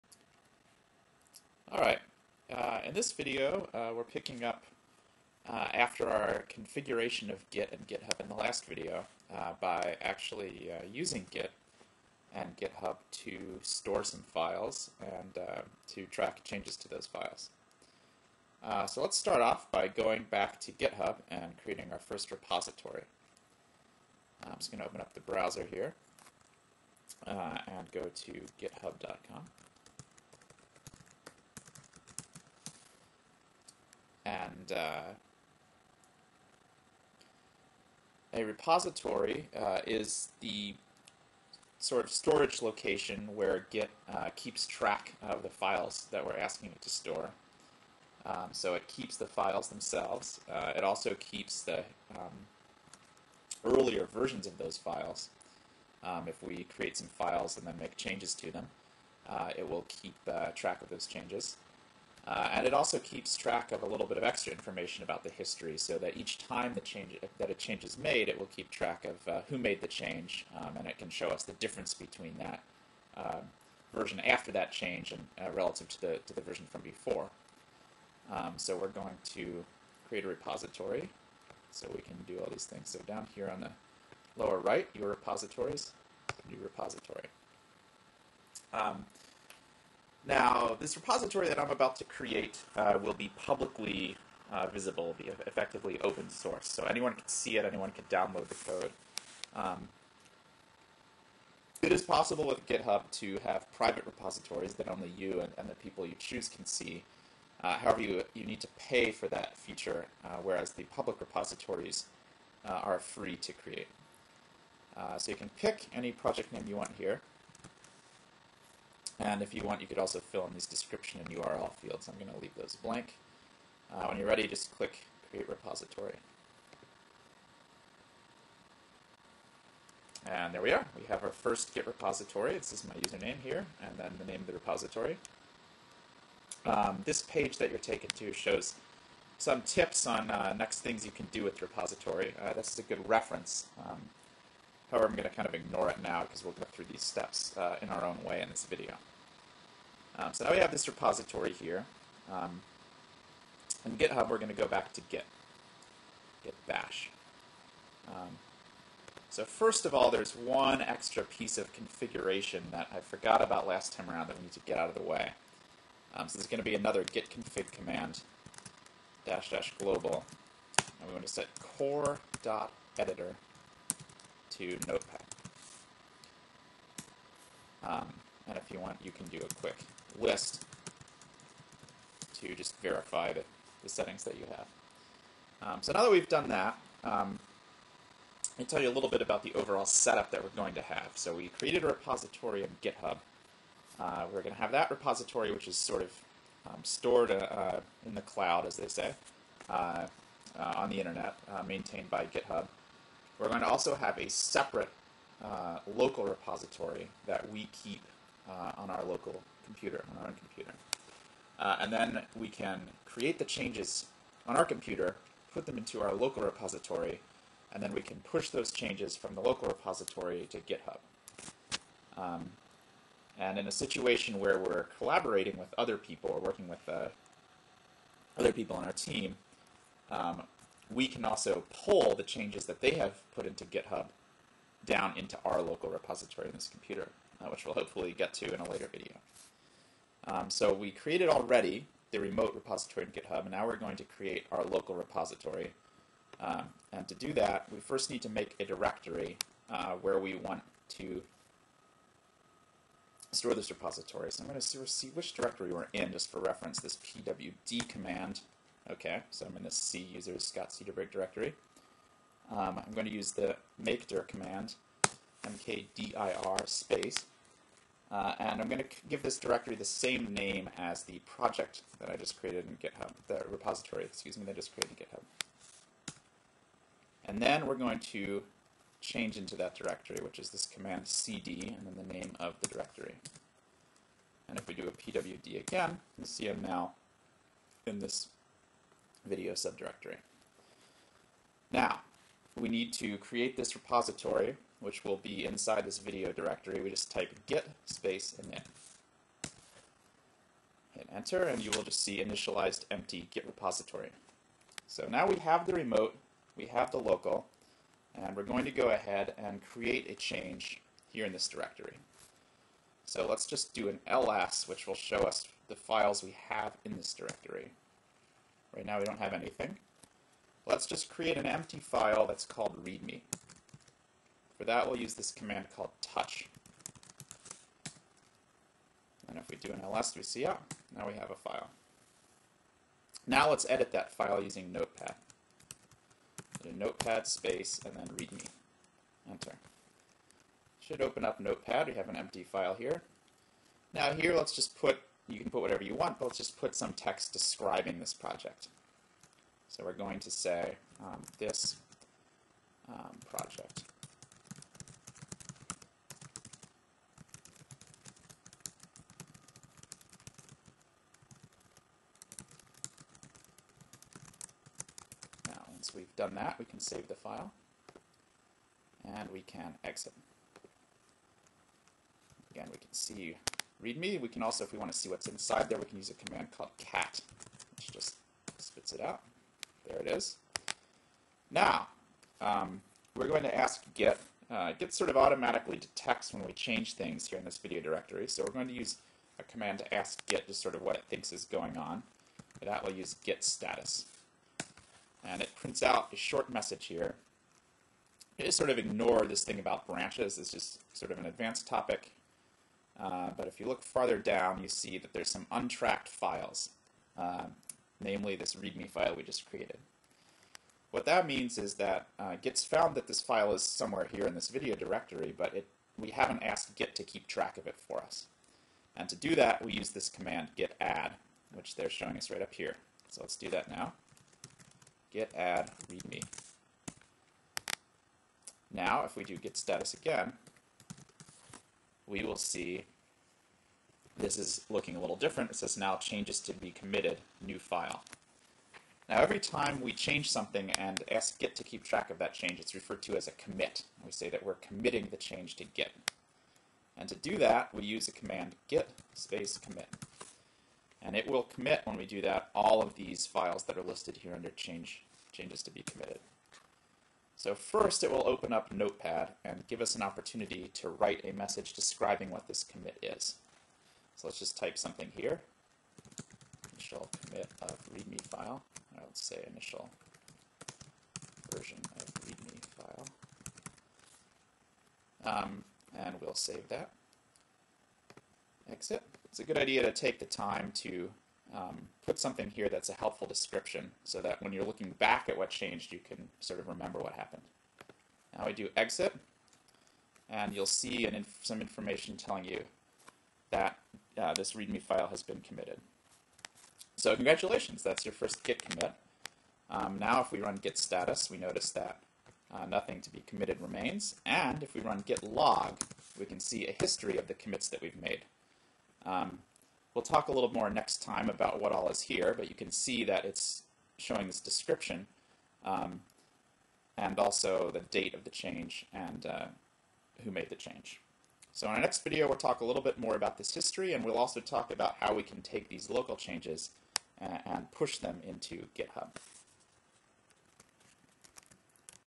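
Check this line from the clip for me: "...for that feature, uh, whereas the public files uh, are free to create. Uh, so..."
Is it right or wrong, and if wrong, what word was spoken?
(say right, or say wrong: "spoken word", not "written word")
wrong: "repositories", not "files".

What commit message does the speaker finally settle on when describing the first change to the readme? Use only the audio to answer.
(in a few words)
Initial version of readme file.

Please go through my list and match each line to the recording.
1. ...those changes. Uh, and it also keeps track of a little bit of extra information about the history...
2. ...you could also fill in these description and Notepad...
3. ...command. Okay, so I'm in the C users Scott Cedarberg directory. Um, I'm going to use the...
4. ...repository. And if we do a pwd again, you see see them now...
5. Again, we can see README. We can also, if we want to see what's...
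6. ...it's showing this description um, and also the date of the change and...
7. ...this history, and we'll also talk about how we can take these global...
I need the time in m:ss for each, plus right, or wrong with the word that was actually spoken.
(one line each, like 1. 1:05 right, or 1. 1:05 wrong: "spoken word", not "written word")
1. 1:00 right
2. 1:59 wrong: "URL", not "Notepad"
3. 4:17 right
4. 4:42 wrong: "directory", not "repository"
5. 6:12 right
6. 8:33 right
7. 8:43 wrong: "local", not "global".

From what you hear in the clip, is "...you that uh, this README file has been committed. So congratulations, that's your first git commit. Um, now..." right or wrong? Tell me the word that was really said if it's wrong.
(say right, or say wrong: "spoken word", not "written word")
right.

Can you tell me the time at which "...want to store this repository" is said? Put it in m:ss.
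4:10.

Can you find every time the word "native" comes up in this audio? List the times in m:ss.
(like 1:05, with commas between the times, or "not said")
not said.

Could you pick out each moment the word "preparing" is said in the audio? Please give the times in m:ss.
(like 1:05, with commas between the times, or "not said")
not said.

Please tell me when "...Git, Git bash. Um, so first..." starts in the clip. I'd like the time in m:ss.
2:35.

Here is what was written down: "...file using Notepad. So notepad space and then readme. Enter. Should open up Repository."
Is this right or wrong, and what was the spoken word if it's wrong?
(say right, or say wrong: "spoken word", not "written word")
wrong: "Notepad", not "Repository".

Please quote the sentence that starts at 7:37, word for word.
So first it will open up Notepad and give us an opportunity to write a message describing what this commit is.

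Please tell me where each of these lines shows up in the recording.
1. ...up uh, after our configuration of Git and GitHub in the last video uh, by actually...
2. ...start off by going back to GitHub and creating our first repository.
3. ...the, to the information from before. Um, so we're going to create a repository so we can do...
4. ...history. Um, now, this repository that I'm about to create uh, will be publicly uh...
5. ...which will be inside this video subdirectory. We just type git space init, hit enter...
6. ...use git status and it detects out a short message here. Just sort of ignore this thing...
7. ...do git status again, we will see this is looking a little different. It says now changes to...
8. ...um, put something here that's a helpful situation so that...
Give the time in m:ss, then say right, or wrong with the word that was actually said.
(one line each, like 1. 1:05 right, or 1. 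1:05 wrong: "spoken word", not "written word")
1. 0:04 right
2. 0:19 right
3. 1:15 wrong: "version", not "information"
4. 1:26 wrong: "repository", not "history"
5. 4:54 wrong: "directory", not "subdirectory"
6. 6:32 wrong: "prints", not "detects"
7. 7:09 right
8. 8:01 wrong: "description", not "situation".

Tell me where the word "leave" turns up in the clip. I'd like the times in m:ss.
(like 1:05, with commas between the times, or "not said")
2:02.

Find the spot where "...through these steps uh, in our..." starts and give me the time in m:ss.
2:26.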